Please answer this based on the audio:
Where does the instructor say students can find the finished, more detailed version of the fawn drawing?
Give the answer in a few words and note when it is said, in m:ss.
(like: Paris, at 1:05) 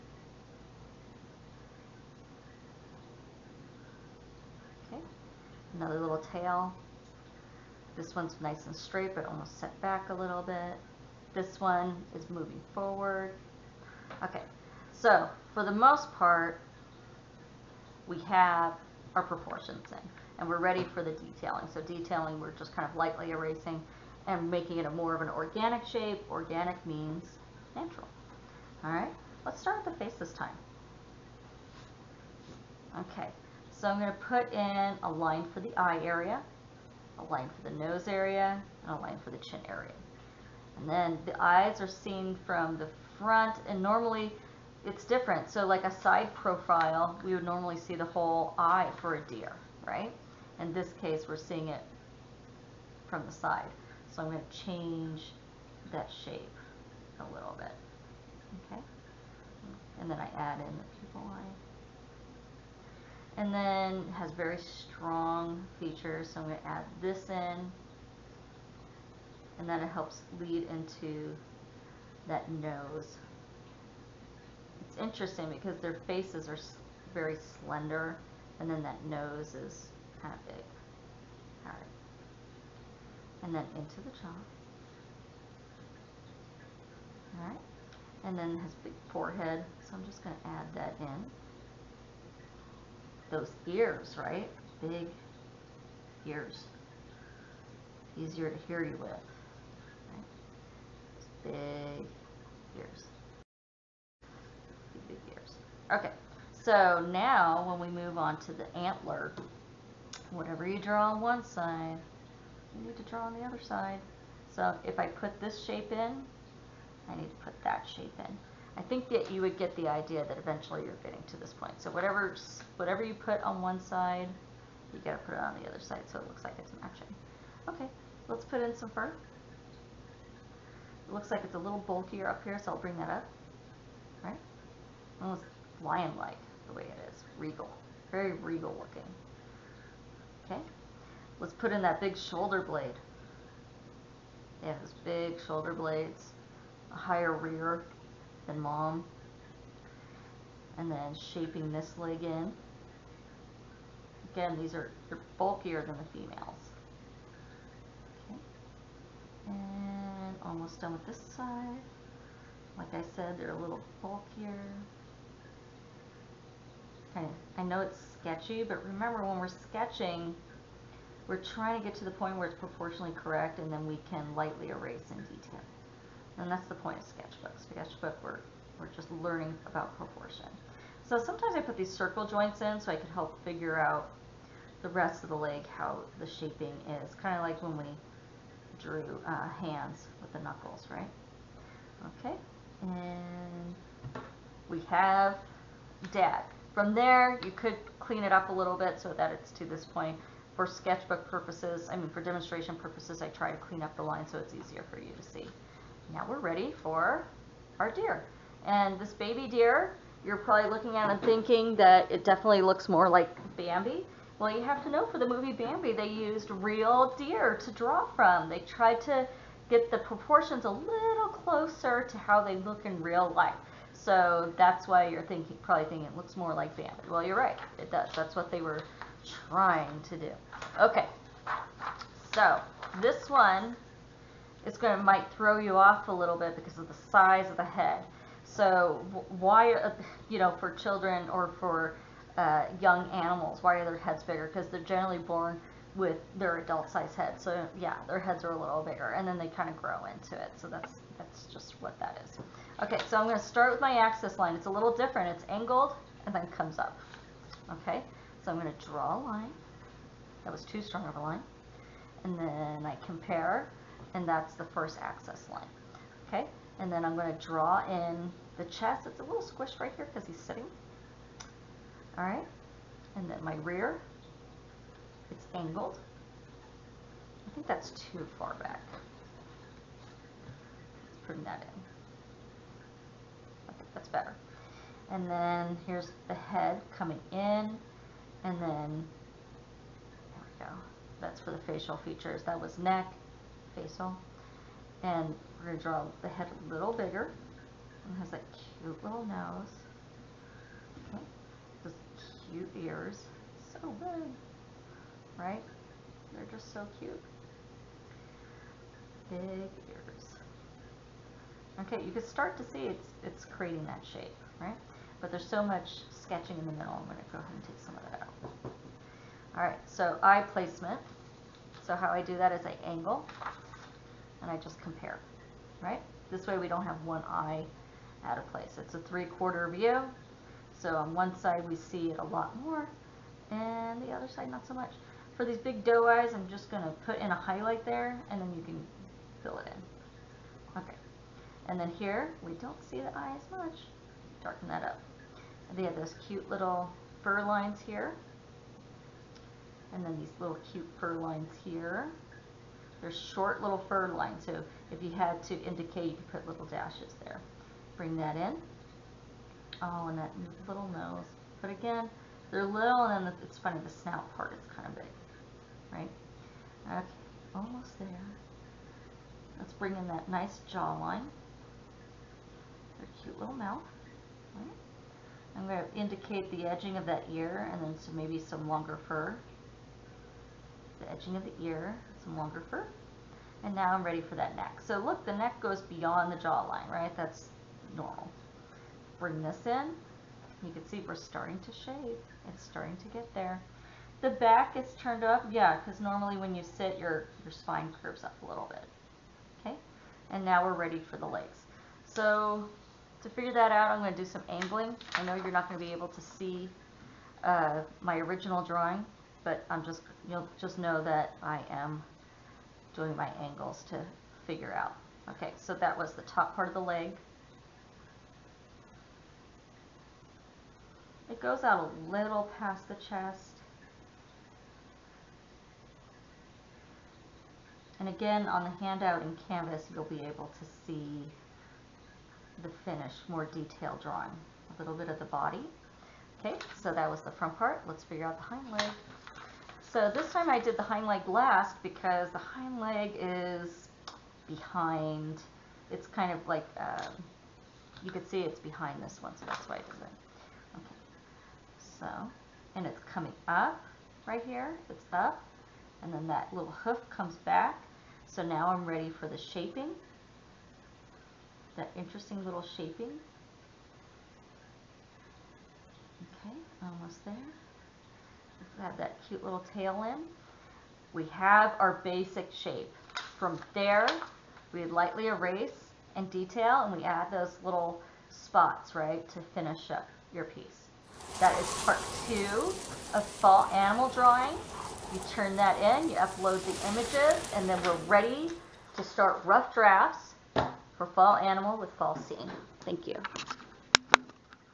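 Canvas, at 7:09.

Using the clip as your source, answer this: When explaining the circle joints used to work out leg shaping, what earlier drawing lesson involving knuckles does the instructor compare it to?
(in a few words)
Hands.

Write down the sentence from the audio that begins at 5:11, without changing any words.
Okay, you can start to see it's, it's creating that shape, right?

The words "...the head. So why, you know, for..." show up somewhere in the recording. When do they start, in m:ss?
3:57.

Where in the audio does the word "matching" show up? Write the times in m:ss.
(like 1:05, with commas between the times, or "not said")
2:06.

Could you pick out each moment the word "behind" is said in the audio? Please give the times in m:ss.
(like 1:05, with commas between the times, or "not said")
7:24, 7:28.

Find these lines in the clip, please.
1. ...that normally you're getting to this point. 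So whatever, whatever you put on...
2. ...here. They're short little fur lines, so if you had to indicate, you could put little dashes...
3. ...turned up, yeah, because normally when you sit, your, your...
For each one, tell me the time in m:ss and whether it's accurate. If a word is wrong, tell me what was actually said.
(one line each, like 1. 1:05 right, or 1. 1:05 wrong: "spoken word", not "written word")
1. 2:00 wrong: "eventually", not "normally"
2. 5:51 right
3. 6:34 right.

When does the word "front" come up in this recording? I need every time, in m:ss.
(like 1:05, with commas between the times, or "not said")
0:43, 7:17.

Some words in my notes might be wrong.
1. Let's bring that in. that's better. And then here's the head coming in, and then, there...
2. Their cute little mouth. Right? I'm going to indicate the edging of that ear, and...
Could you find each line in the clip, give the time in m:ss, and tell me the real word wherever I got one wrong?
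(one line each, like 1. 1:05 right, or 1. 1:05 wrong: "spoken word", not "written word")
1. 4:41 right
2. 6:12 right.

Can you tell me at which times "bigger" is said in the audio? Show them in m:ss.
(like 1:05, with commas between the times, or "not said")
4:04, 4:08, 4:56.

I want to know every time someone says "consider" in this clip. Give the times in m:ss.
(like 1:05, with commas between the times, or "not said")
not said.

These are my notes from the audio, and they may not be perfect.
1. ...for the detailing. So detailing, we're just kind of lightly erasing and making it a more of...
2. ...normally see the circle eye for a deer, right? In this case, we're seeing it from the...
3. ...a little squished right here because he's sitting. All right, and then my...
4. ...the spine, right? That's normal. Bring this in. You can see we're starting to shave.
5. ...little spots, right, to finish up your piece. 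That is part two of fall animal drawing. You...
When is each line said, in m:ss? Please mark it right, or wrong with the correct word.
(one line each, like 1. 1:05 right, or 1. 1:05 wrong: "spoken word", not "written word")
1. 0:20 right
2. 0:47 wrong: "whole", not "circle"
3. 4:29 right
4. 6:26 wrong: "jawline", not "spine"
5. 7:57 right.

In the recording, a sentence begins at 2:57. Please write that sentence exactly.
Sketchbook, we're, we're just learning about proportion.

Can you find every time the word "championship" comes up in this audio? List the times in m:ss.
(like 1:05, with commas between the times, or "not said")
not said.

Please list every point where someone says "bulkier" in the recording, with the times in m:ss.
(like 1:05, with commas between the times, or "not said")
2:11, 2:35, 2:43.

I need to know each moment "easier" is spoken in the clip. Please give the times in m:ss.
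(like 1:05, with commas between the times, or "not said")
1:38, 3:24.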